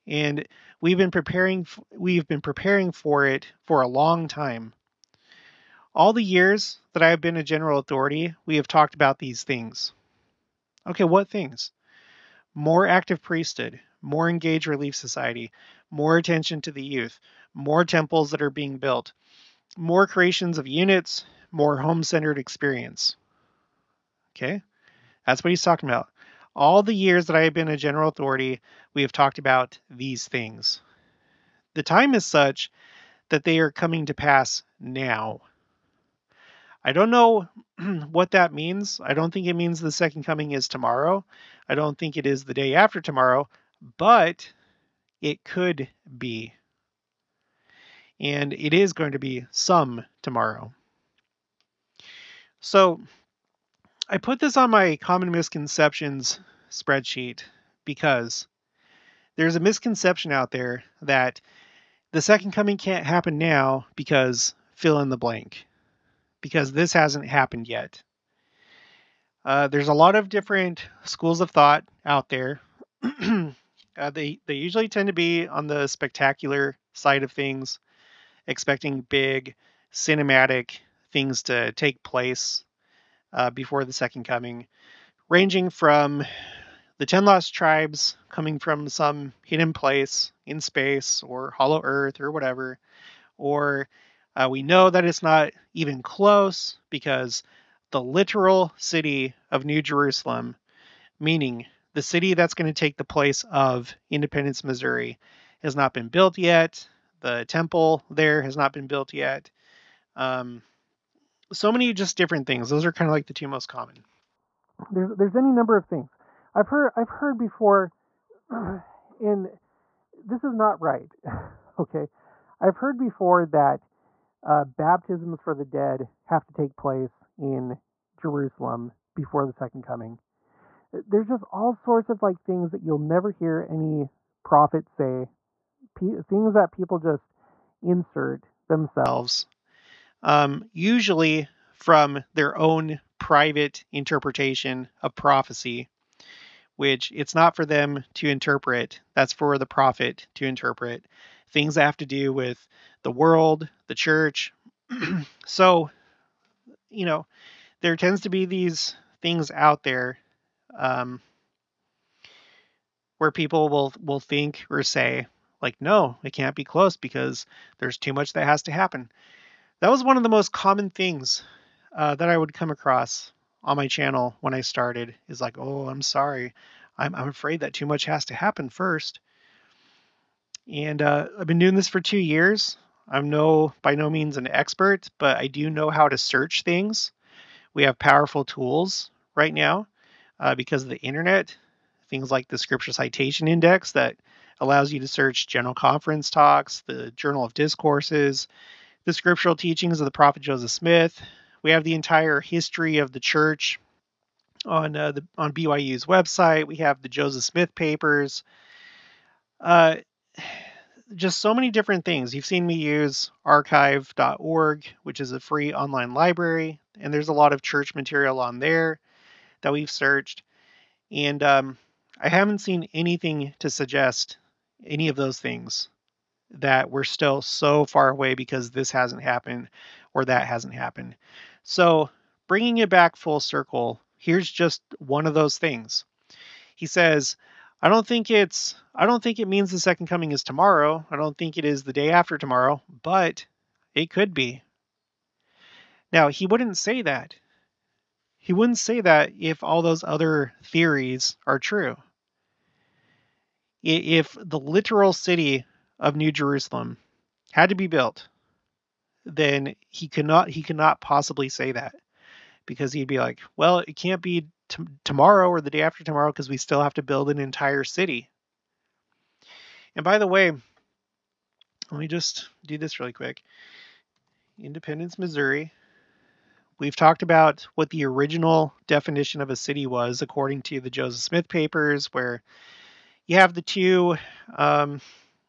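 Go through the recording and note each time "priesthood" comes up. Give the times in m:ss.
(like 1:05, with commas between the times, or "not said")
0:13.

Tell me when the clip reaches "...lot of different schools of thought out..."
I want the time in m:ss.
1:09.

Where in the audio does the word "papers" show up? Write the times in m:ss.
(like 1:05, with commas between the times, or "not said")
3:27, 4:41.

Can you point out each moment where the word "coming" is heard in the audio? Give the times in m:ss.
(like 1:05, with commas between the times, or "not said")
0:33, 0:40, 1:02, 1:24, 1:28, 2:09, 4:00.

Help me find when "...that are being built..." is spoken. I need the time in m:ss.
0:18.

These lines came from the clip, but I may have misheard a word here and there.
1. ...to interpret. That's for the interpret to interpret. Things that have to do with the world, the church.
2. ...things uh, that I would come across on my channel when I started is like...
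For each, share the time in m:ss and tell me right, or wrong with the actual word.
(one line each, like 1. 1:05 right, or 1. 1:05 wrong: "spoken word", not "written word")
1. 2:28 wrong: "prophet", not "interpret"
2. 2:50 right.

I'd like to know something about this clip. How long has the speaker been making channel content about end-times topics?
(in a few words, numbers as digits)
2 years.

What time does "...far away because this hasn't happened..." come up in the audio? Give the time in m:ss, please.
3:47.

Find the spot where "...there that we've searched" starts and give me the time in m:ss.
3:38.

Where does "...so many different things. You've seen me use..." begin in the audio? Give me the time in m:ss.
3:31.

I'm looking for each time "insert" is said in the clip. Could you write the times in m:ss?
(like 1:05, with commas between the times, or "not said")
2:17.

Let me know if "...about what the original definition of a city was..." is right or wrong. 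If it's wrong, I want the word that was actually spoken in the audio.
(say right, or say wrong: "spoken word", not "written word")
right.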